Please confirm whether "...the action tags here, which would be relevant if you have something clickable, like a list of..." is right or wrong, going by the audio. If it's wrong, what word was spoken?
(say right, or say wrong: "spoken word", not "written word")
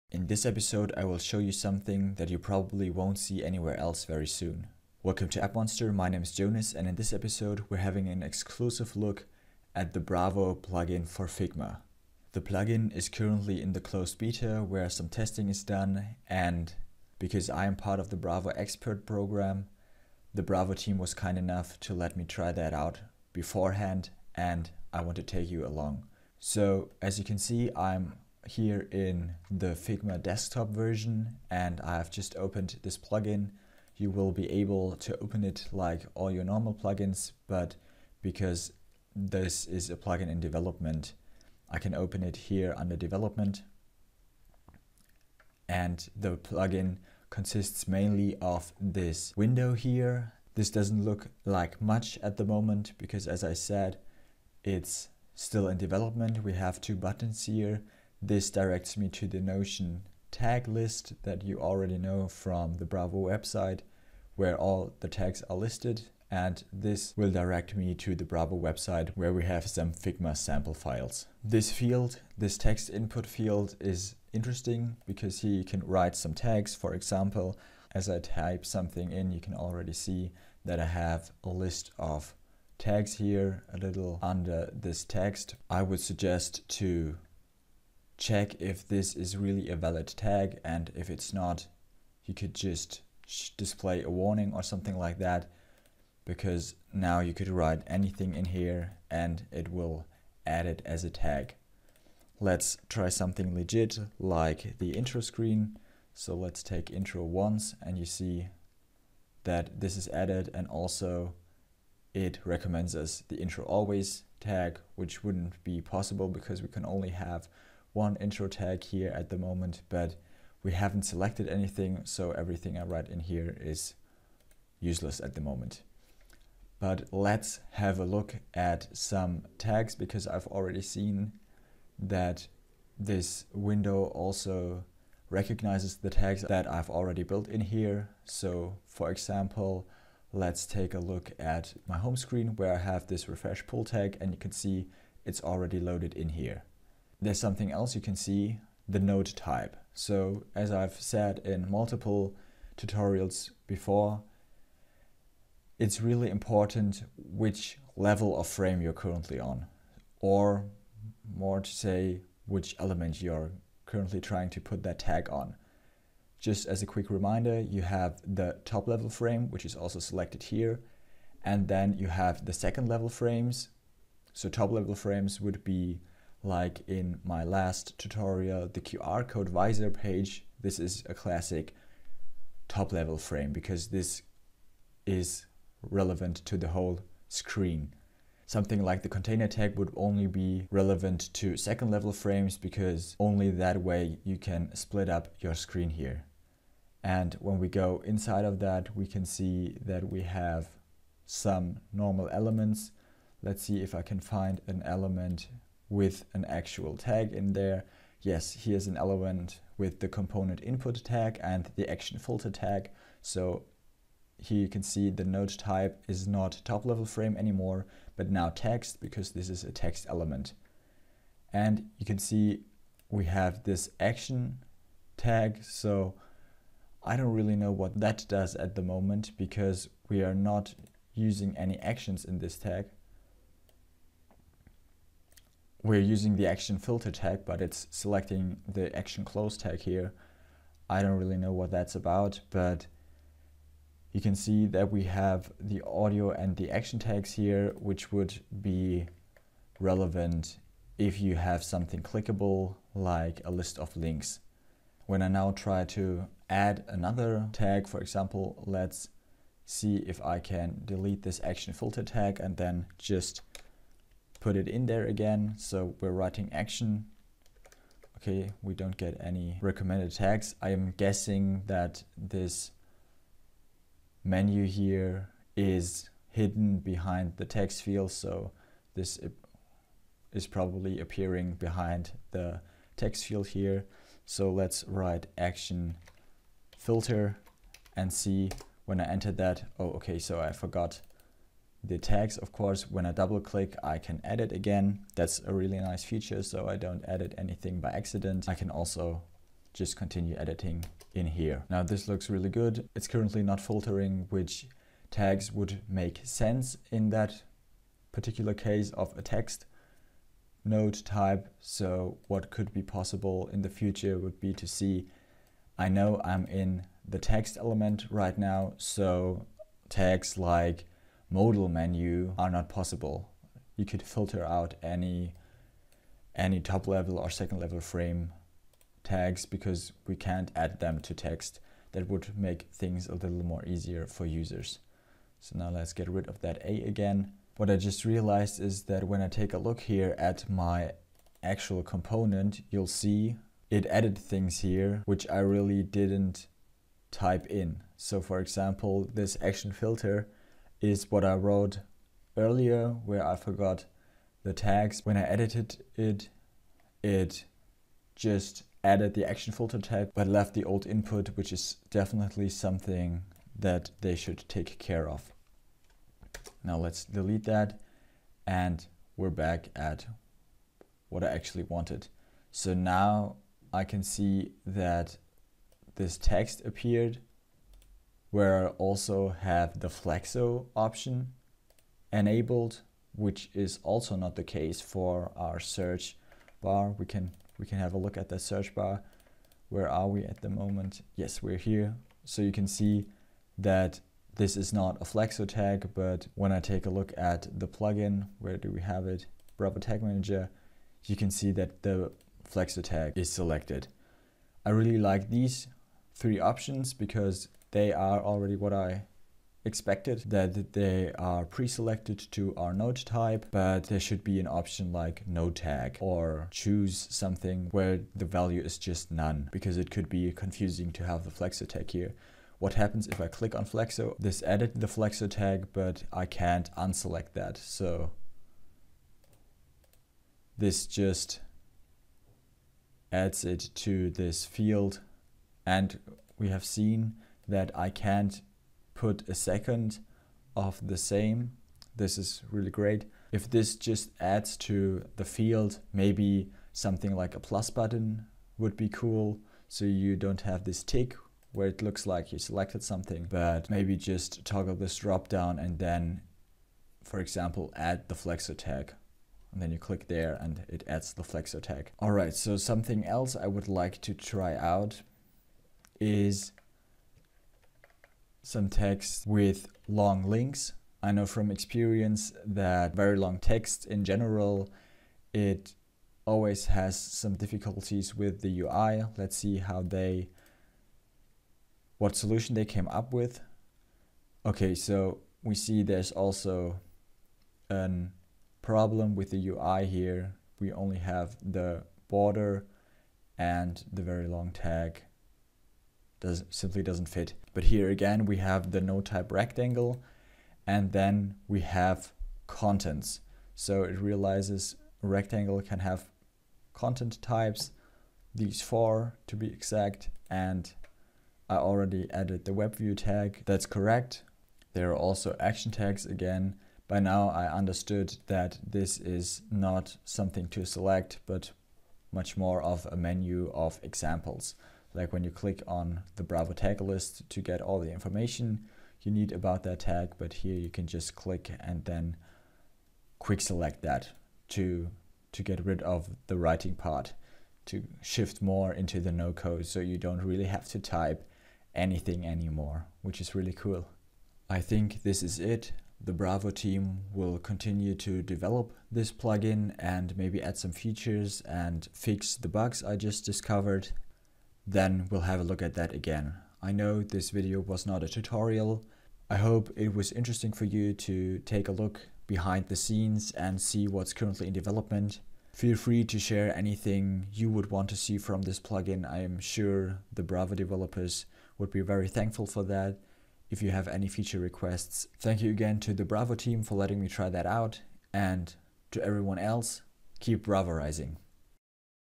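right.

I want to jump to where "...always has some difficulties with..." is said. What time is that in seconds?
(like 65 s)
476 s.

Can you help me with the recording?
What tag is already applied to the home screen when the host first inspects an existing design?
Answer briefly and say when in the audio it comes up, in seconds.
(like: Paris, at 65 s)
refresh pull, at 143 s.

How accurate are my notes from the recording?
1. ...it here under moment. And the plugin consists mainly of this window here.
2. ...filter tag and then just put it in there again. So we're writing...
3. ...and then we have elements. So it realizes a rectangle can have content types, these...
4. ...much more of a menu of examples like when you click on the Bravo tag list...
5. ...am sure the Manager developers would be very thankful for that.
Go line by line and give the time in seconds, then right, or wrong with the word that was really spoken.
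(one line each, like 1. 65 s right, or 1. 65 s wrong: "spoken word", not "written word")
1. 42 s wrong: "development", not "moment"
2. 261 s right
3. 500 s wrong: "contents", not "elements"
4. 522 s right
5. 569 s wrong: "Bravo", not "Manager".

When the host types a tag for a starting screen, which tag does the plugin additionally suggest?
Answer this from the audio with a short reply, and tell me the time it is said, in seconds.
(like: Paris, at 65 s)
intro always, at 113 s.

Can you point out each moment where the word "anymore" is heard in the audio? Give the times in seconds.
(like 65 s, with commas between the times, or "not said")
217 s, 542 s.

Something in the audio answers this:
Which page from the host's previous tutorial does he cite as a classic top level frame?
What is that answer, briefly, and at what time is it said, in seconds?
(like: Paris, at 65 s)
QR code visor page, at 178 s.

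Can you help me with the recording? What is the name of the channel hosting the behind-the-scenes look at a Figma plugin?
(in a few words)
App Monster.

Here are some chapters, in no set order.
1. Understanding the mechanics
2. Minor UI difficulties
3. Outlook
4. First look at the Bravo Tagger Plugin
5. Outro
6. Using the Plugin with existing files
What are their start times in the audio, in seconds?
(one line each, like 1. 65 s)
1. 497 s
2. 462 s
3. 545 s
4. 27 s
5. 573 s
6. 126 s.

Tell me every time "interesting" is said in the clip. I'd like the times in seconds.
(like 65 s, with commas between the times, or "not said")
74 s, 560 s.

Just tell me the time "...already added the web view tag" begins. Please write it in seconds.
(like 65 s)
511 s.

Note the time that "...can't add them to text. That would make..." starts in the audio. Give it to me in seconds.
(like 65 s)
330 s.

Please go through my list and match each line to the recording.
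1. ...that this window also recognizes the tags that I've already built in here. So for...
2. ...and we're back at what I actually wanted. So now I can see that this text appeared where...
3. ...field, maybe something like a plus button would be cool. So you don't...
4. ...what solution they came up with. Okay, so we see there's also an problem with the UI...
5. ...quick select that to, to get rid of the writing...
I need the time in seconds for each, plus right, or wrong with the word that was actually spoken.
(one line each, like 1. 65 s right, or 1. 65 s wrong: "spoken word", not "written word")
1. 131 s right
2. 368 s right
3. 445 s right
4. 481 s right
5. 533 s right.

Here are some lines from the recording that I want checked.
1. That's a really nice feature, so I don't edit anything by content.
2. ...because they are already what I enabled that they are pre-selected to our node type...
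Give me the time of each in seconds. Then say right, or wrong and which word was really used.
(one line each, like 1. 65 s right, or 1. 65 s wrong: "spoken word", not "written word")
1. 295 s wrong: "accident", not "content"
2. 406 s wrong: "expected", not "enabled".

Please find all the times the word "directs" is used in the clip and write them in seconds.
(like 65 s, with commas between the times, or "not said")
58 s, 67 s.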